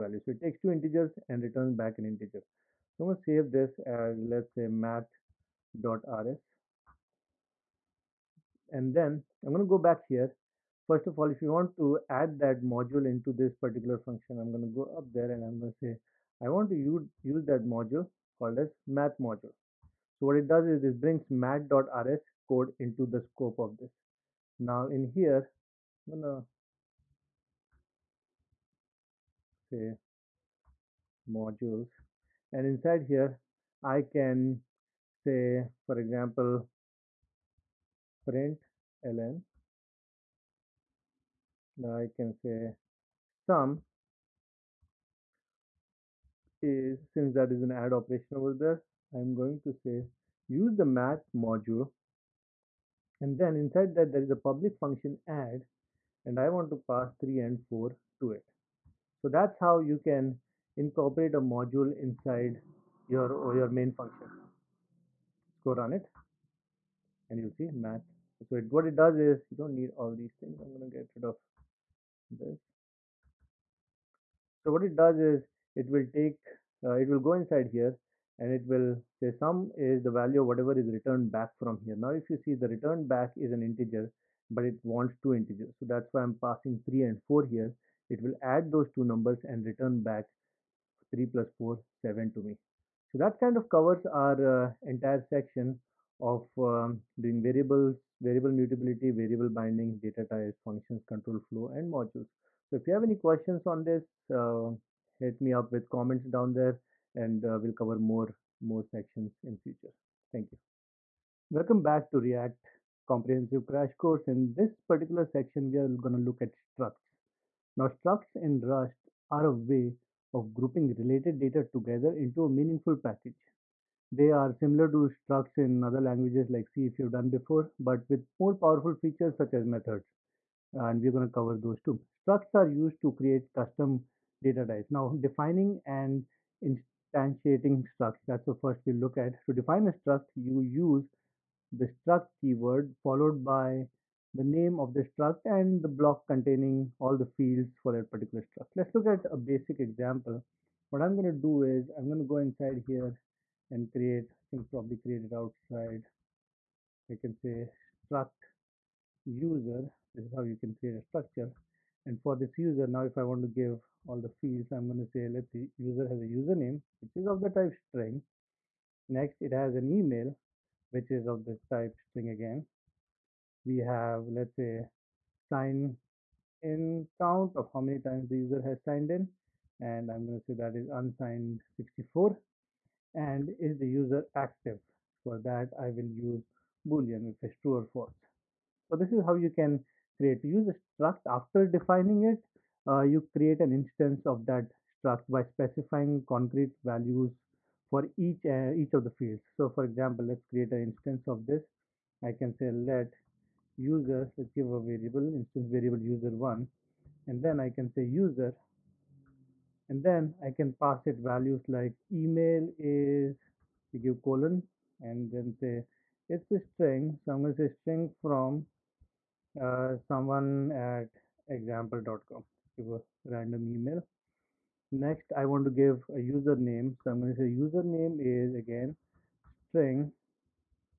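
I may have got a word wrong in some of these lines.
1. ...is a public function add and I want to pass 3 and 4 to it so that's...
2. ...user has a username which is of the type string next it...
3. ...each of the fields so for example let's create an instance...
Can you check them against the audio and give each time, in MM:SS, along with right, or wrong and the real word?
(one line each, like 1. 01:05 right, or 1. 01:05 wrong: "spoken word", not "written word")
1. 00:54 right
2. 02:45 right
3. 03:18 right.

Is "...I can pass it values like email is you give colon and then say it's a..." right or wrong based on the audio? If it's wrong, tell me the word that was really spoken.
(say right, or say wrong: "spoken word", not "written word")
right.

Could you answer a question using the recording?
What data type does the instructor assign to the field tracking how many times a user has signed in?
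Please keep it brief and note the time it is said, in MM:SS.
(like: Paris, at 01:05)
unsigned 64, at 03:00.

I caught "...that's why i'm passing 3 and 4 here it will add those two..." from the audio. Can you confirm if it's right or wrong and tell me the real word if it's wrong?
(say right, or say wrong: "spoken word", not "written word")
right.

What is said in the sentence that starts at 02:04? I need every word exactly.
They are similar to structs in other languages like C if you've done before, but with more powerful features such as methods.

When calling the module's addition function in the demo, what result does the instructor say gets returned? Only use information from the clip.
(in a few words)
7.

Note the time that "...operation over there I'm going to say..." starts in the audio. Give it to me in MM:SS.
00:47.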